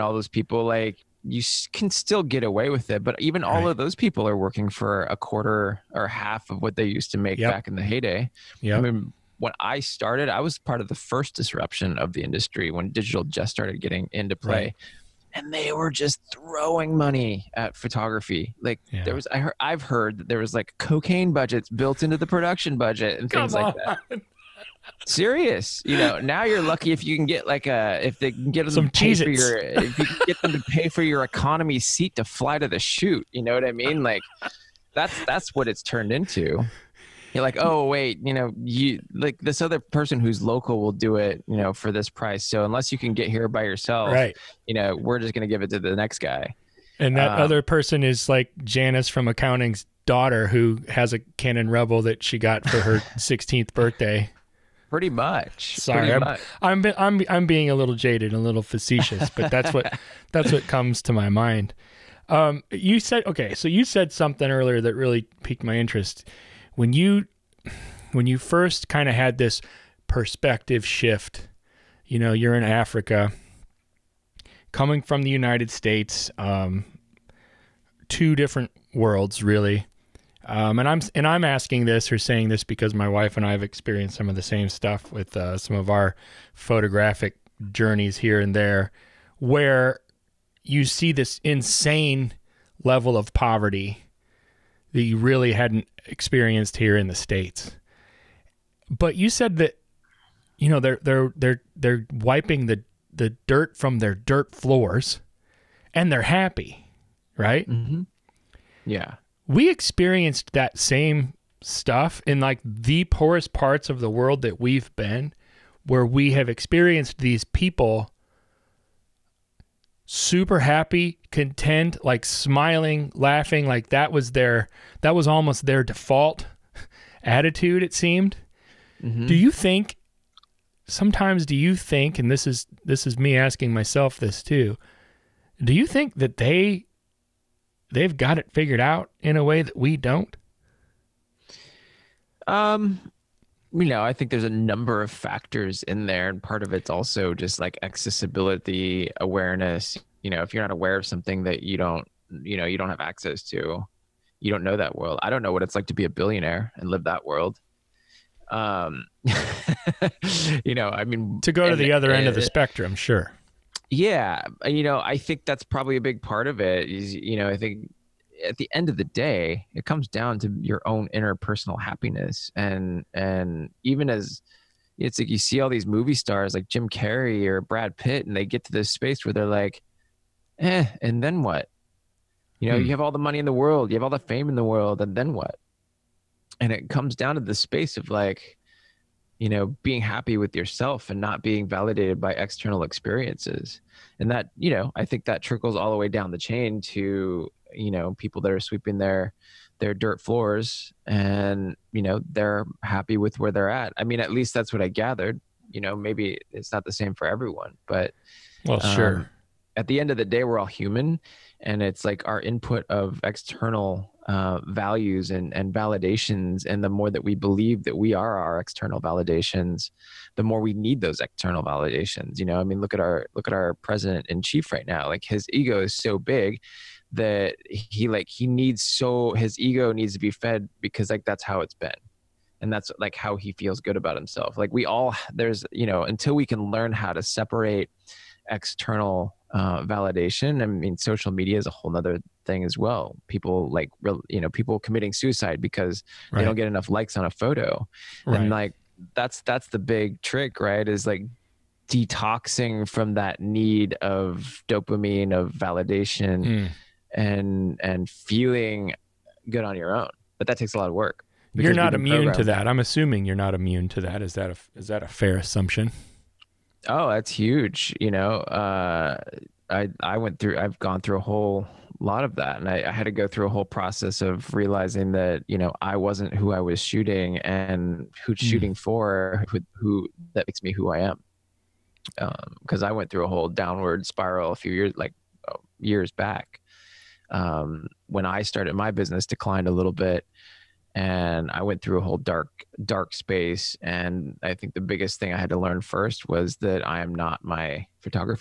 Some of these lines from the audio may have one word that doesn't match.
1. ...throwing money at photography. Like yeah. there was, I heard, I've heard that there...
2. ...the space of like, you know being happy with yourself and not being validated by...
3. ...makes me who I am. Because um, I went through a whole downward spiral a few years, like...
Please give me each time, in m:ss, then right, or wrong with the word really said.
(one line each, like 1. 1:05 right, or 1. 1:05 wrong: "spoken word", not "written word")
1. 0:16 right
2. 3:07 right
3. 4:40 right.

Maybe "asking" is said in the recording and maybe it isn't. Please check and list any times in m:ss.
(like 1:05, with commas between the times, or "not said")
1:21, 2:13.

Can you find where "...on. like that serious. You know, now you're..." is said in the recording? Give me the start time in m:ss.
0:23.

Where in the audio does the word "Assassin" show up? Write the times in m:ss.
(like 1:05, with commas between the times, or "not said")
not said.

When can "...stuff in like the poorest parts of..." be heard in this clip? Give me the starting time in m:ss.
1:51.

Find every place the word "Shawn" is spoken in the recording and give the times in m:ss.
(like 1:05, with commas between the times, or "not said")
not said.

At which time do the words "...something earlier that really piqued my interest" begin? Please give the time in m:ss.
1:04.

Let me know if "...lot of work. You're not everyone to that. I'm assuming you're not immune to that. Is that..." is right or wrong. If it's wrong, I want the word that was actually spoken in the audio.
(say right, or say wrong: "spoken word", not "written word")
wrong: "immune", not "everyone".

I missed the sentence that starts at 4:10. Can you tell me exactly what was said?
Is like detoxing from that need of dopamine of validation mm.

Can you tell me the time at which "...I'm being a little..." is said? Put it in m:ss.
0:57.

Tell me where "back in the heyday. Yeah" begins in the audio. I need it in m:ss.
0:07.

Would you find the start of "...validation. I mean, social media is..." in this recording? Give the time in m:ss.
3:59.